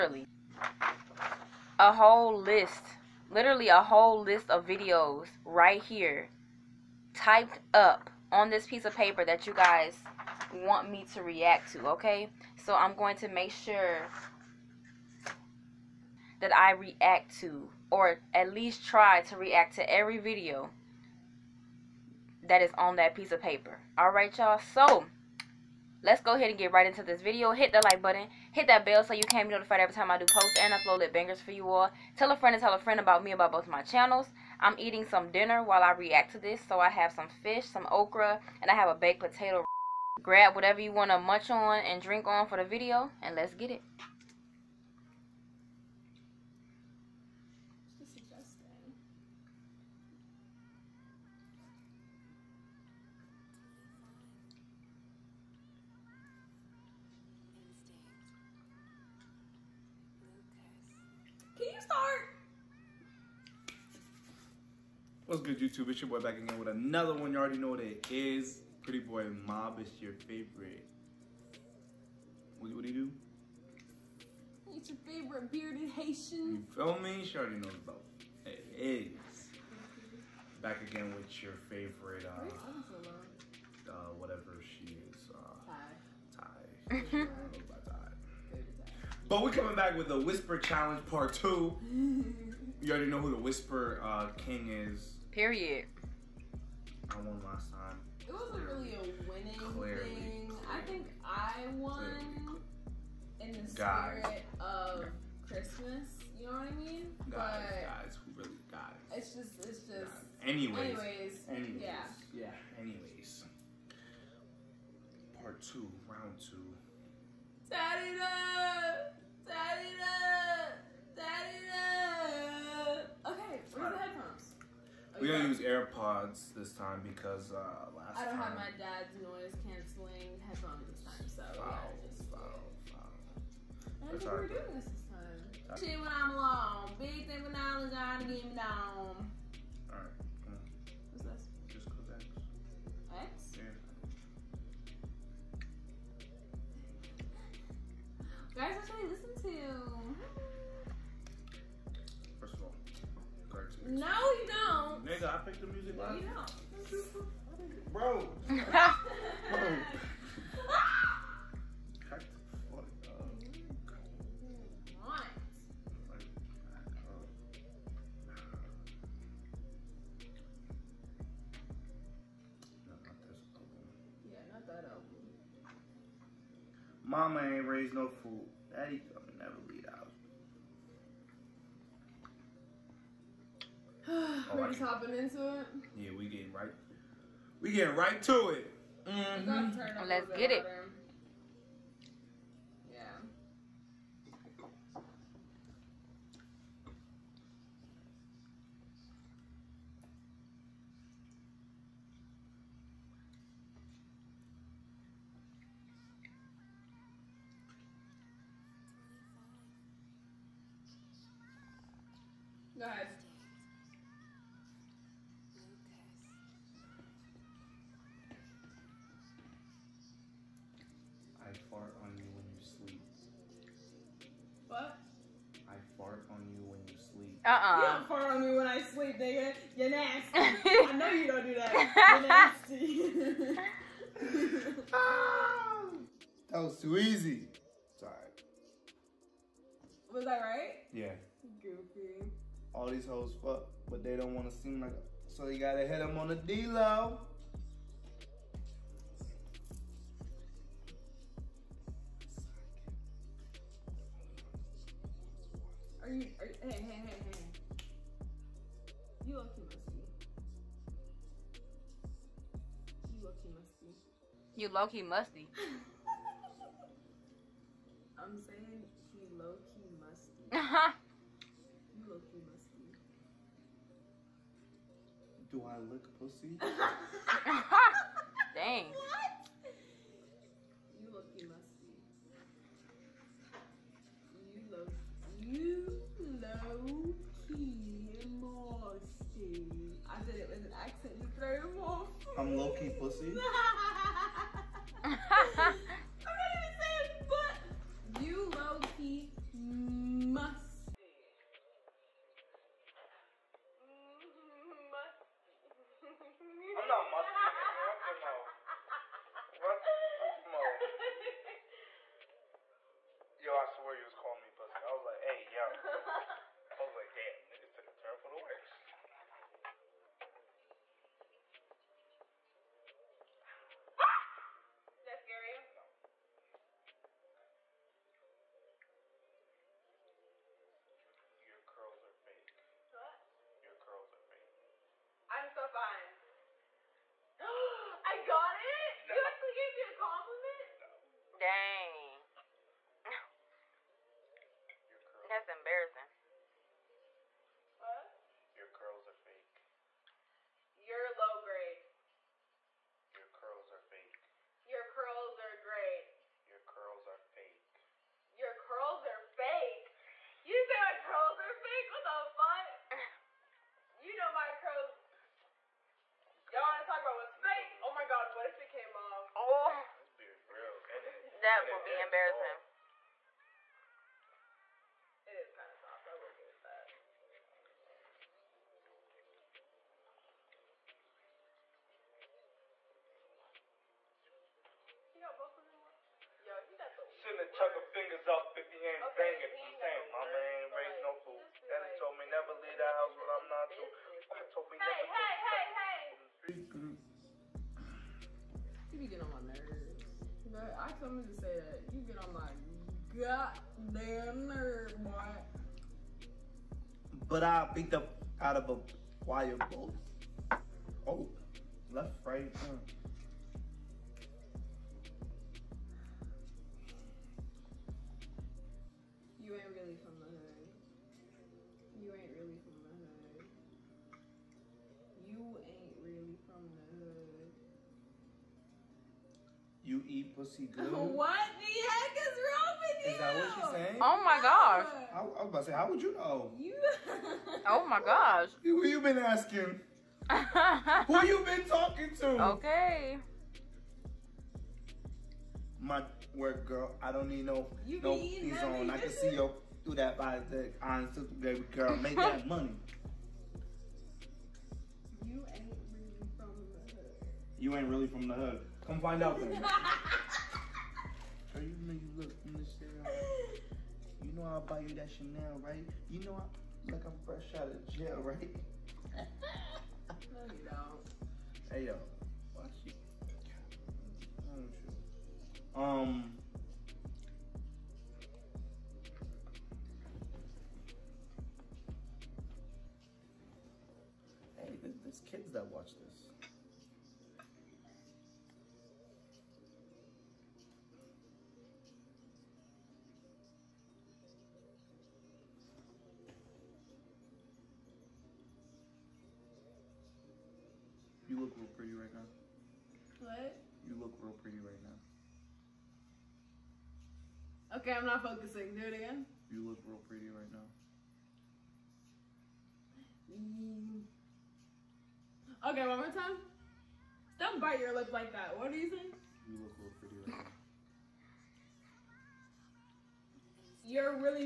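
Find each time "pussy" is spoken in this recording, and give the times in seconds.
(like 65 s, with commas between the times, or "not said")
276 s, 292 s, 314 s, 430 s.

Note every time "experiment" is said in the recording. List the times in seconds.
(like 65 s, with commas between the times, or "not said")
not said.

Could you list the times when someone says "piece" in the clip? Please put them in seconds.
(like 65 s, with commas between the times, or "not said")
8 s, 23 s.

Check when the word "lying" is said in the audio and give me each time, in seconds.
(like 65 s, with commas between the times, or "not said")
not said.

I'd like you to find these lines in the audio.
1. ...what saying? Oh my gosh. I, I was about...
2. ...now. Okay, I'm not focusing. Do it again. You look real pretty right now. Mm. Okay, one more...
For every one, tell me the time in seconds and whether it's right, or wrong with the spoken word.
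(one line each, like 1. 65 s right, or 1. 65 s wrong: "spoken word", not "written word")
1. 433 s right
2. 507 s right.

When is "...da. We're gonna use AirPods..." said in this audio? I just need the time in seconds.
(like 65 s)
121 s.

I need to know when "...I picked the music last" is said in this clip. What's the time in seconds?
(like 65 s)
155 s.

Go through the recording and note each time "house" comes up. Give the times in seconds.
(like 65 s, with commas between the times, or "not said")
392 s.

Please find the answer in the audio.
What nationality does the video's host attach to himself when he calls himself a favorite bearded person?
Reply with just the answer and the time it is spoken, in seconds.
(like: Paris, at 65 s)
Haitian, at 75 s.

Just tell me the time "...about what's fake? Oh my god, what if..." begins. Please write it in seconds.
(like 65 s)
367 s.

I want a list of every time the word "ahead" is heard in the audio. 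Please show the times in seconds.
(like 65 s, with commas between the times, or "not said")
26 s.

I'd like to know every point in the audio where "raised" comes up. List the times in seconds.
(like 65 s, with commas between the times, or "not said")
177 s, 390 s.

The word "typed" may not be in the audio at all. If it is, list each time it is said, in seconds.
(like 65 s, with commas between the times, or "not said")
7 s.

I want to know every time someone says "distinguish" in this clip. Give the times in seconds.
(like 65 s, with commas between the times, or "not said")
not said.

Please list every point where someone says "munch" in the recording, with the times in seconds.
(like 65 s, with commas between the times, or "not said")
41 s.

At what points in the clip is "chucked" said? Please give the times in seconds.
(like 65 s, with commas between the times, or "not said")
387 s.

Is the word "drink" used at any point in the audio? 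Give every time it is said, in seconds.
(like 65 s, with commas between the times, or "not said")
42 s.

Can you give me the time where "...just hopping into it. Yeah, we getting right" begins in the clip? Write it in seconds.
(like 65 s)
184 s.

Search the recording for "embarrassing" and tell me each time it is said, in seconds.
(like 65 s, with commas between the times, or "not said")
345 s, 371 s.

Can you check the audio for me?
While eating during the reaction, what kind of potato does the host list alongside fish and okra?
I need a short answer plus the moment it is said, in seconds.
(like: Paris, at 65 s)
Baked potato, at 38 s.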